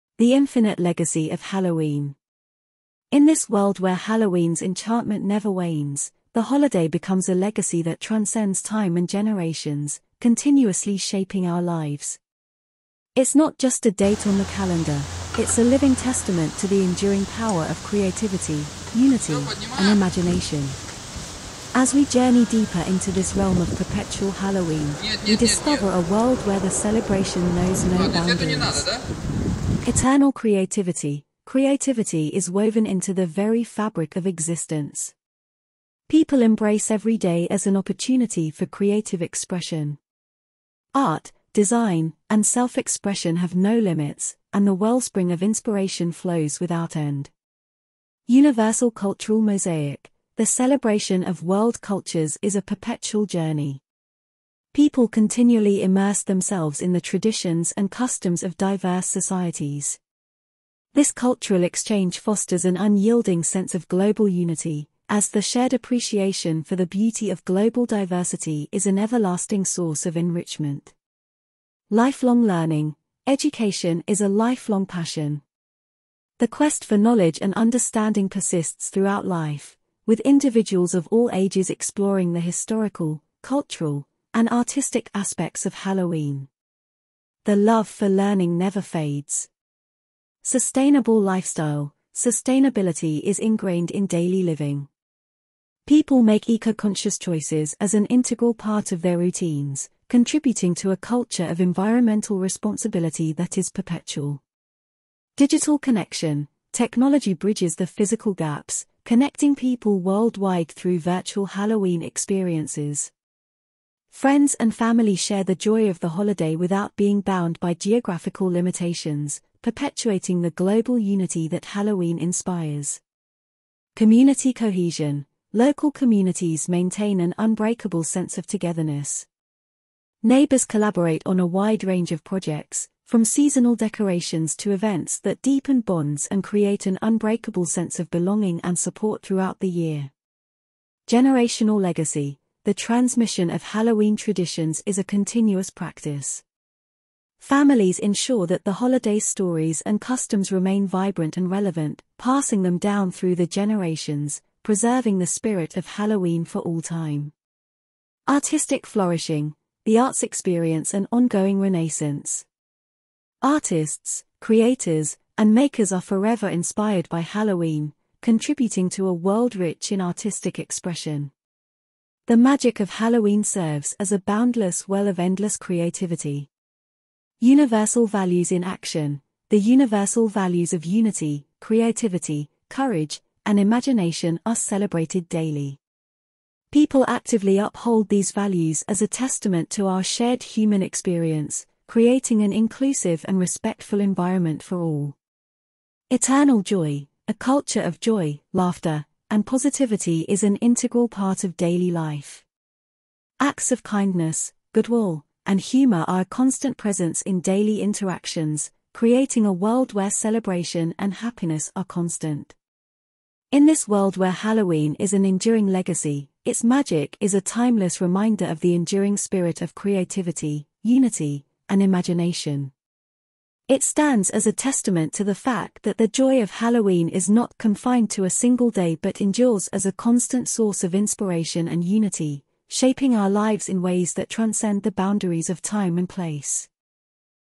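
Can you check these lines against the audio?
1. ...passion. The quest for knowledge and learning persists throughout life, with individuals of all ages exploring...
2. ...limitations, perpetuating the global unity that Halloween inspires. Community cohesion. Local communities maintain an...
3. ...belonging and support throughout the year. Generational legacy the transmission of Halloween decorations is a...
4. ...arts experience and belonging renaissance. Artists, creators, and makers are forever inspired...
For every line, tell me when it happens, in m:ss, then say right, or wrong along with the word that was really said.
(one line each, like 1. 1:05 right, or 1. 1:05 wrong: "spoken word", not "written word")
1. 1:14 wrong: "understanding", not "learning"
2. 1:58 right
3. 2:18 wrong: "traditions", not "decorations"
4. 2:39 wrong: "ongoing", not "belonging".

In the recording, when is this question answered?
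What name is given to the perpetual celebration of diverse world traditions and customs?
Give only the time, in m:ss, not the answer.
0:48.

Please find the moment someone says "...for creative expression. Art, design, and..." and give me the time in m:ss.
0:38.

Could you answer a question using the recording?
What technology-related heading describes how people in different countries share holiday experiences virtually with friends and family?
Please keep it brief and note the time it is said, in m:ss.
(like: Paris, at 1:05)
Digital connection, at 1:45.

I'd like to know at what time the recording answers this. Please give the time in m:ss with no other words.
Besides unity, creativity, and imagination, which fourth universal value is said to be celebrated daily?
3:02.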